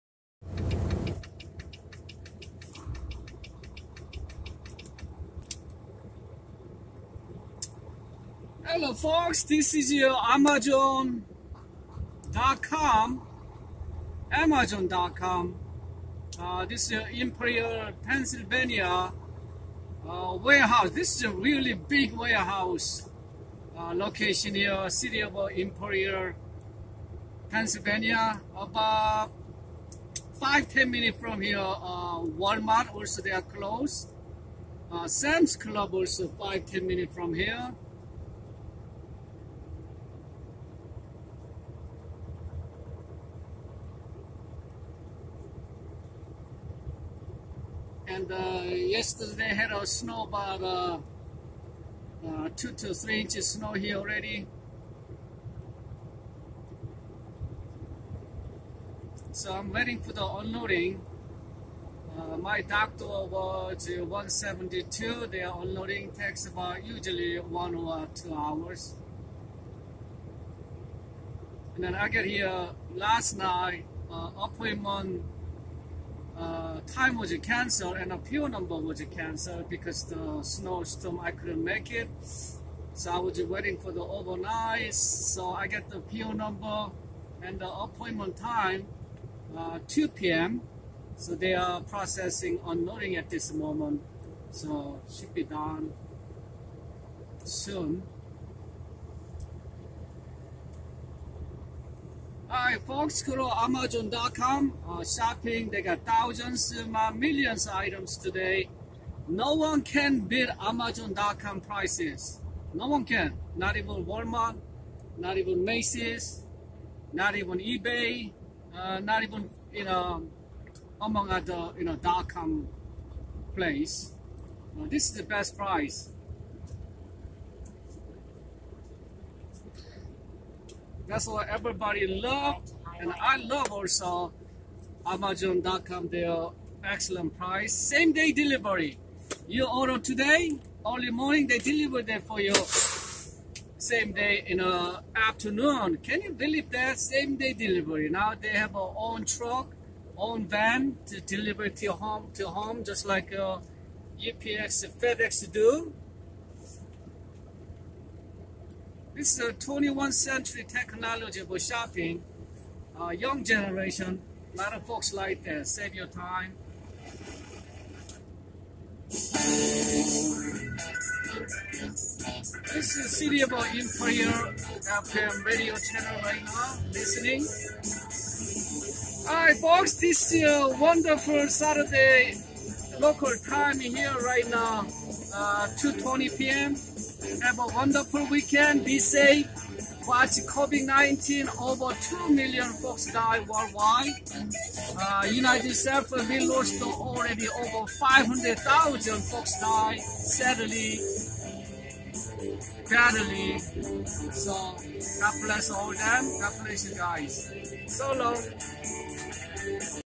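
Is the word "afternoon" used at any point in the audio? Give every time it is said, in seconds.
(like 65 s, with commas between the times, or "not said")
145 s.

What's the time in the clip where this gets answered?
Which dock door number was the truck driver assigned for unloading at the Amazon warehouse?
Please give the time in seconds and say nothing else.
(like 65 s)
64 s.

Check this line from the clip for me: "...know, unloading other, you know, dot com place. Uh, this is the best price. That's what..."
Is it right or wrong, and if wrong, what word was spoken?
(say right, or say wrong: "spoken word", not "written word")
wrong: "among", not "unloading".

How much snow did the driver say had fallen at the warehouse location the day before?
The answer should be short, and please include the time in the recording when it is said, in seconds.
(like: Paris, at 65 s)
2 to 3 inches, at 52 s.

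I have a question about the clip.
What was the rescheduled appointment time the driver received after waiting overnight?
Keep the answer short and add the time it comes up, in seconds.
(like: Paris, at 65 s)
2 p.m., at 89 s.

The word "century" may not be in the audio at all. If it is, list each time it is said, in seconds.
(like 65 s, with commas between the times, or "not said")
160 s.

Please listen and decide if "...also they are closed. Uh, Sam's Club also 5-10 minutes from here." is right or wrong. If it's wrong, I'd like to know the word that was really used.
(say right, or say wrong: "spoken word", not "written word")
right.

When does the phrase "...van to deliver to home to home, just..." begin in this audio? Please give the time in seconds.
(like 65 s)
150 s.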